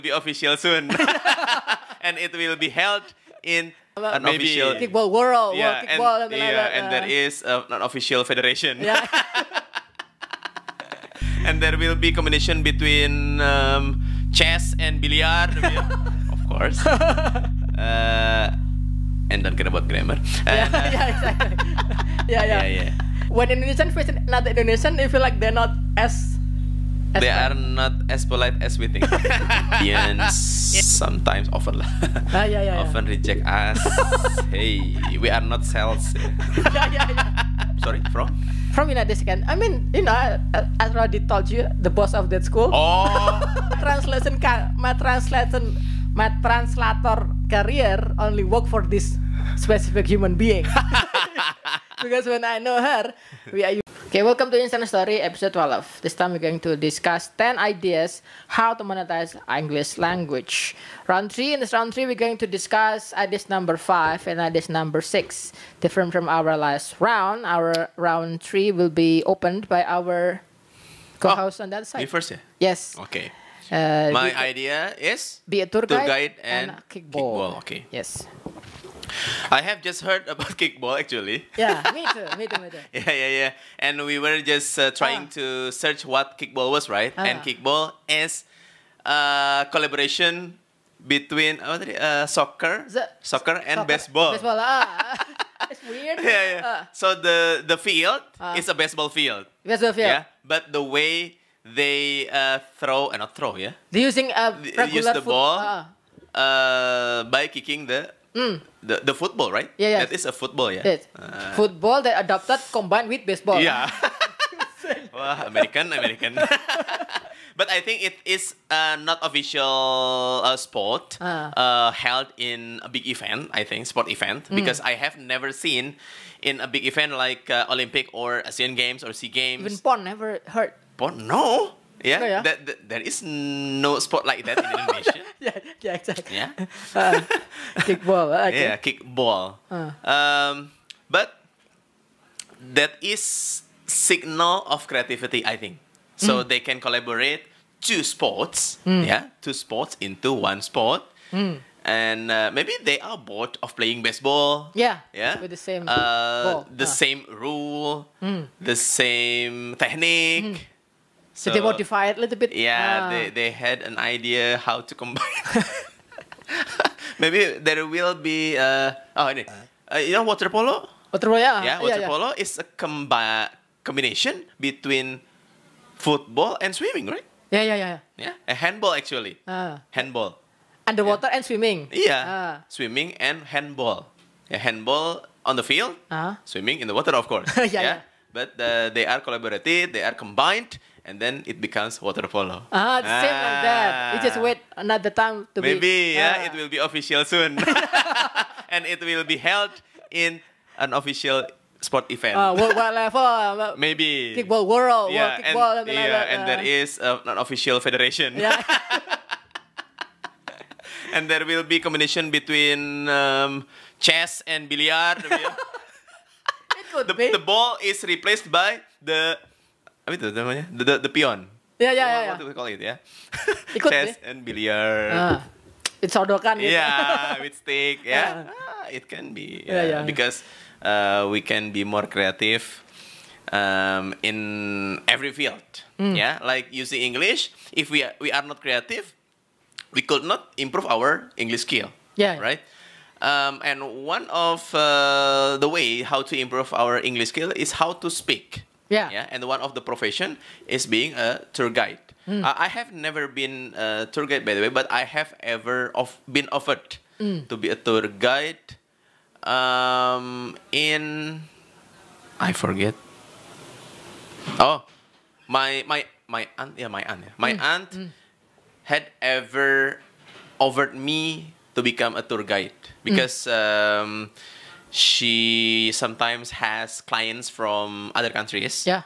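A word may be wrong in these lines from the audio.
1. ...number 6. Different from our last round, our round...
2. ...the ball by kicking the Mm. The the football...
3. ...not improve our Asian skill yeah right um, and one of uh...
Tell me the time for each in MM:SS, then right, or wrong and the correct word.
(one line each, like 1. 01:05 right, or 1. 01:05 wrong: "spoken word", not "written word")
1. 01:04 right
2. 01:45 right
3. 04:00 wrong: "English", not "Asian".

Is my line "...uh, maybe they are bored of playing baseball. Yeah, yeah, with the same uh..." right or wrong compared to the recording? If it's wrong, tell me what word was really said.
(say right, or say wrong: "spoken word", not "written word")
right.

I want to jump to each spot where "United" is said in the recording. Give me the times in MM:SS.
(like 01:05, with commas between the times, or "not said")
00:38.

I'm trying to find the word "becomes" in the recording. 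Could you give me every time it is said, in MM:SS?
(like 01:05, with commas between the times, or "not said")
03:11, 04:31.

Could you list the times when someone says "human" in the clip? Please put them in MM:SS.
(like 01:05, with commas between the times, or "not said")
00:50.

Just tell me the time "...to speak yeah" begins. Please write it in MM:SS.
04:07.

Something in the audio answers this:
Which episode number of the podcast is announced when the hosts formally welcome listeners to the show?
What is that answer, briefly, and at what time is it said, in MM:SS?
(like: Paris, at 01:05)
12, at 00:55.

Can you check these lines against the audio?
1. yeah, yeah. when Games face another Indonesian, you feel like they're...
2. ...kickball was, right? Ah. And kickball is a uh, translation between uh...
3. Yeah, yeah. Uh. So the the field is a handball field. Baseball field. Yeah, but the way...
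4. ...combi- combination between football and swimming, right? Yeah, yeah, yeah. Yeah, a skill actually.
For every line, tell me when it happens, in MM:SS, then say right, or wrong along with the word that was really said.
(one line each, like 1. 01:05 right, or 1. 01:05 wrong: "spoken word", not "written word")
1. 00:22 wrong: "Indonesian", not "Games"
2. 01:26 wrong: "collaboration", not "translation"
3. 01:36 wrong: "baseball", not "handball"
4. 02:52 wrong: "handball", not "skill".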